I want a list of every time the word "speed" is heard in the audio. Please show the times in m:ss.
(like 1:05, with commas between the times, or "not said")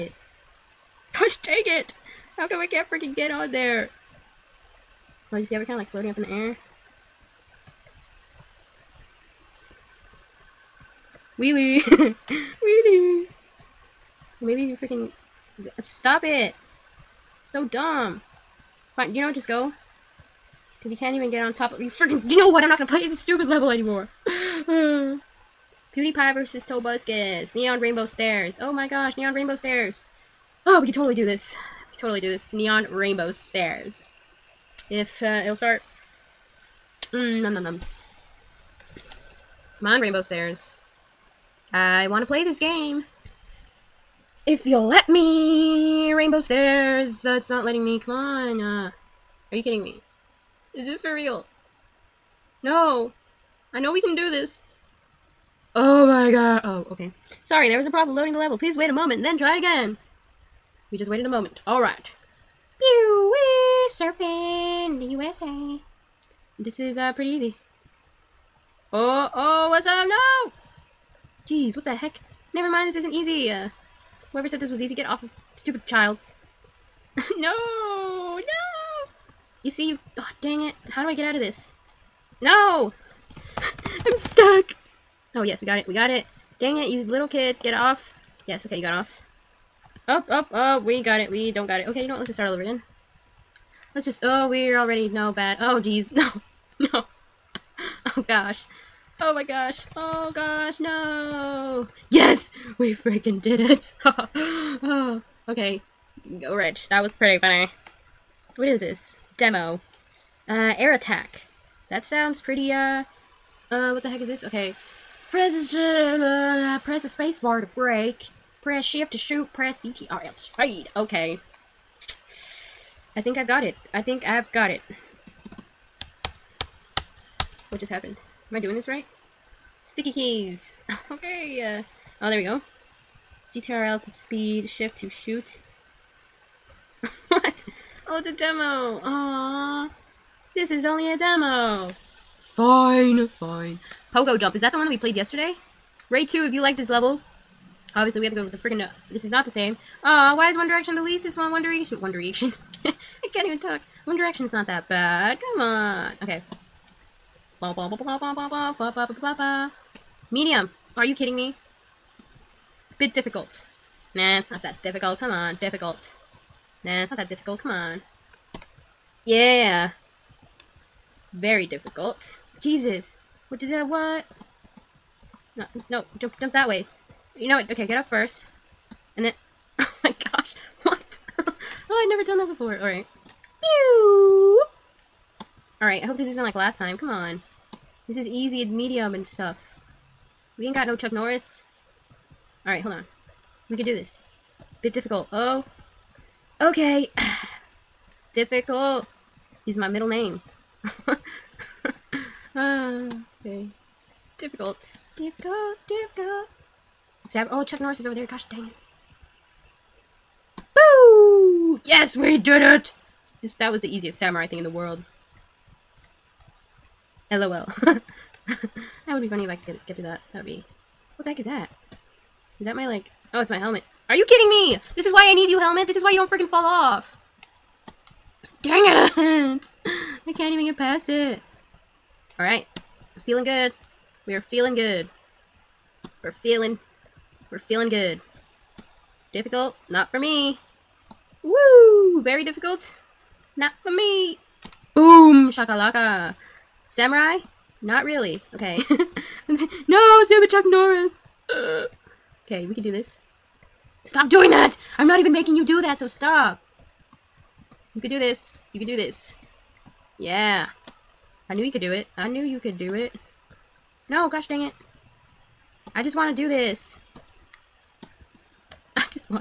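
2:00, 2:14.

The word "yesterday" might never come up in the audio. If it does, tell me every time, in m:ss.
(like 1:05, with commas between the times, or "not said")
2:25.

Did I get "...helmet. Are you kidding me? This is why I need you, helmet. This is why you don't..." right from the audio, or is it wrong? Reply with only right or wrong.
right.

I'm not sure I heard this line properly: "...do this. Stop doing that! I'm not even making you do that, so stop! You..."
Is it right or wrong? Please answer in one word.
right.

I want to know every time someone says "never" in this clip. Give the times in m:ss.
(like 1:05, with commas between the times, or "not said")
1:12, 3:02.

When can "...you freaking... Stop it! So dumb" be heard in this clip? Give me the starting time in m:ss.
0:14.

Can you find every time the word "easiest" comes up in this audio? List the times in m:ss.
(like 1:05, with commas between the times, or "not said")
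3:33.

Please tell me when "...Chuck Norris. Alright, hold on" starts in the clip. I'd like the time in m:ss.
3:10.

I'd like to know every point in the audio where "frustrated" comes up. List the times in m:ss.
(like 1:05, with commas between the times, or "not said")
not said.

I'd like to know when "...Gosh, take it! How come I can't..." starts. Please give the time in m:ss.
0:01.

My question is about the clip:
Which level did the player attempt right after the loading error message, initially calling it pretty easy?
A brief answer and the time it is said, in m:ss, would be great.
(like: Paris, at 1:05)
Pew surfing the USA, at 1:02.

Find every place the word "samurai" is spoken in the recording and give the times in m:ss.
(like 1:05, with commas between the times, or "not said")
3:34, 4:06.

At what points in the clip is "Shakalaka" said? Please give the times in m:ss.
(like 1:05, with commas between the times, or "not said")
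4:05.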